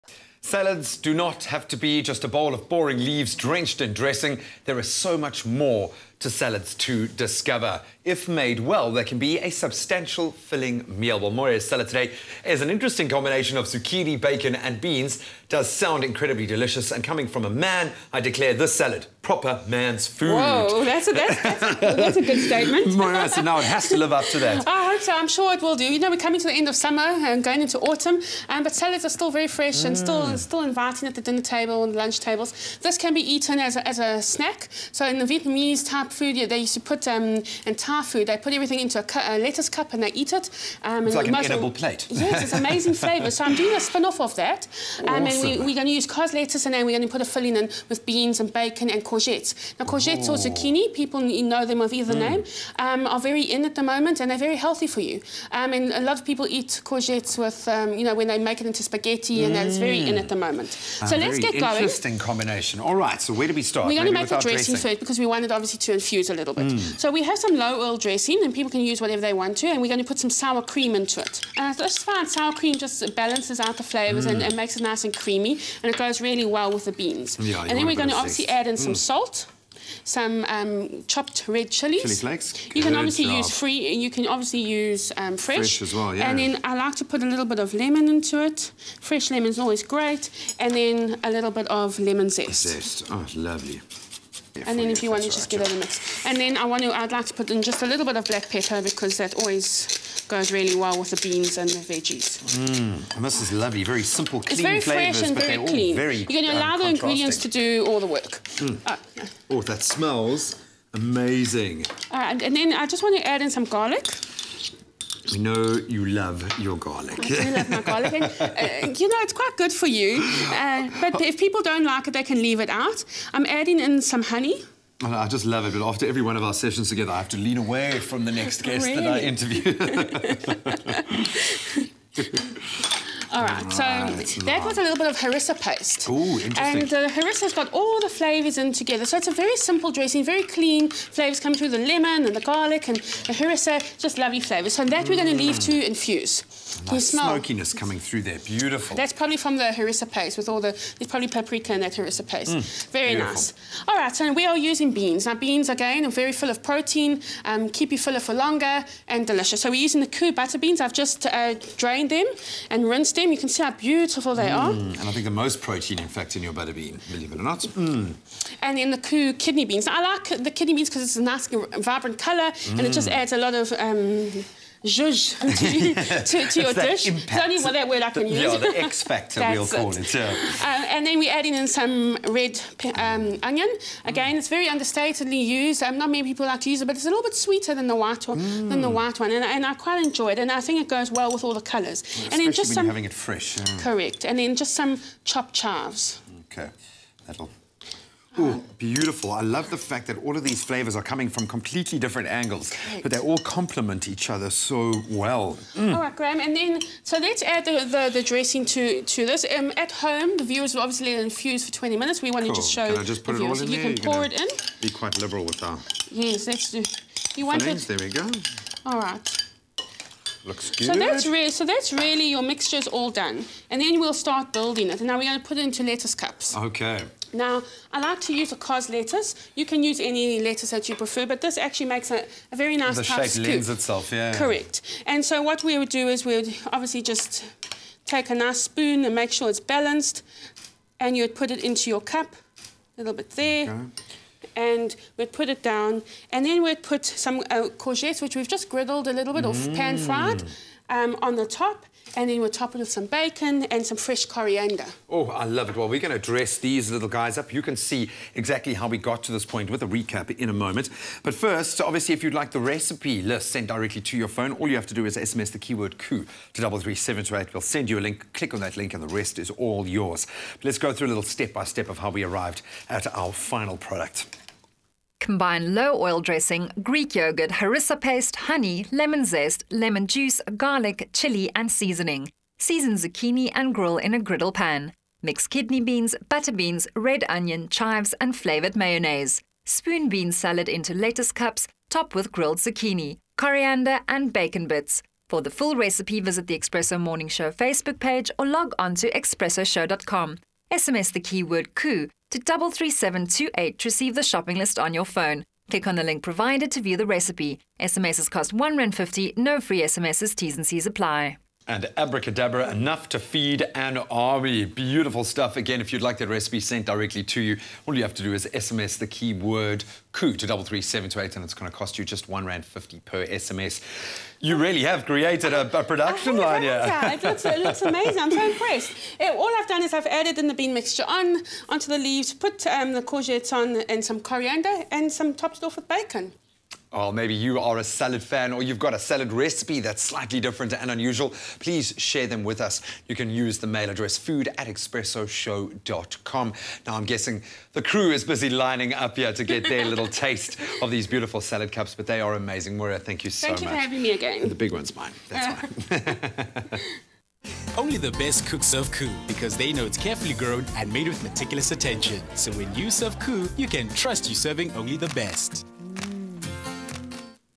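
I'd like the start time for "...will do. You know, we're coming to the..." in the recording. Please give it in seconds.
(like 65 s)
25 s.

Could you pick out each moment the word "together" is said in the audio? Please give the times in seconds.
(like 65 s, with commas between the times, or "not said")
126 s, 138 s.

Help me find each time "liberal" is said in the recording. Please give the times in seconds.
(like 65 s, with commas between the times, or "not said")
215 s.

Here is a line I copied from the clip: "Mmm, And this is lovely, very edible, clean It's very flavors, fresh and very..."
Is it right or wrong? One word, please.
wrong.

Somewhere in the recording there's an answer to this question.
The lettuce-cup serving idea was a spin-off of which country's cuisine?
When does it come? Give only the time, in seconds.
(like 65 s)
35 s.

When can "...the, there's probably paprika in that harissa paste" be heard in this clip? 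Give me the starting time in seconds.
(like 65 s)
150 s.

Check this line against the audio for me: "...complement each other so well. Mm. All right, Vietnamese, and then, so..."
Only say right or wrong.
wrong.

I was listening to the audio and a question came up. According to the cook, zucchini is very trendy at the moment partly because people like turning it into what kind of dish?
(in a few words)
spaghetti.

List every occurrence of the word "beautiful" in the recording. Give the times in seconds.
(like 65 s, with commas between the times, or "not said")
148 s, 153 s, 163 s, 198 s, 314 s, 351 s.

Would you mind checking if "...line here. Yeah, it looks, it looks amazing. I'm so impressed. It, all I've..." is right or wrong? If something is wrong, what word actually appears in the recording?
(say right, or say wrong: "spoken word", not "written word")
right.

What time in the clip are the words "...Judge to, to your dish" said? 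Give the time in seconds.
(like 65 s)
174 s.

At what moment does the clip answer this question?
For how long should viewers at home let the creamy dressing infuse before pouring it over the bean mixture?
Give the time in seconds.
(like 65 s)
211 s.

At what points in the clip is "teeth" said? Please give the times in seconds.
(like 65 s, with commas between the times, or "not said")
not said.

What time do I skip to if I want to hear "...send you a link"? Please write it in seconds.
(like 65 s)
267 s.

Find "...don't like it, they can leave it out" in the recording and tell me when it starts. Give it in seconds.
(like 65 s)
121 s.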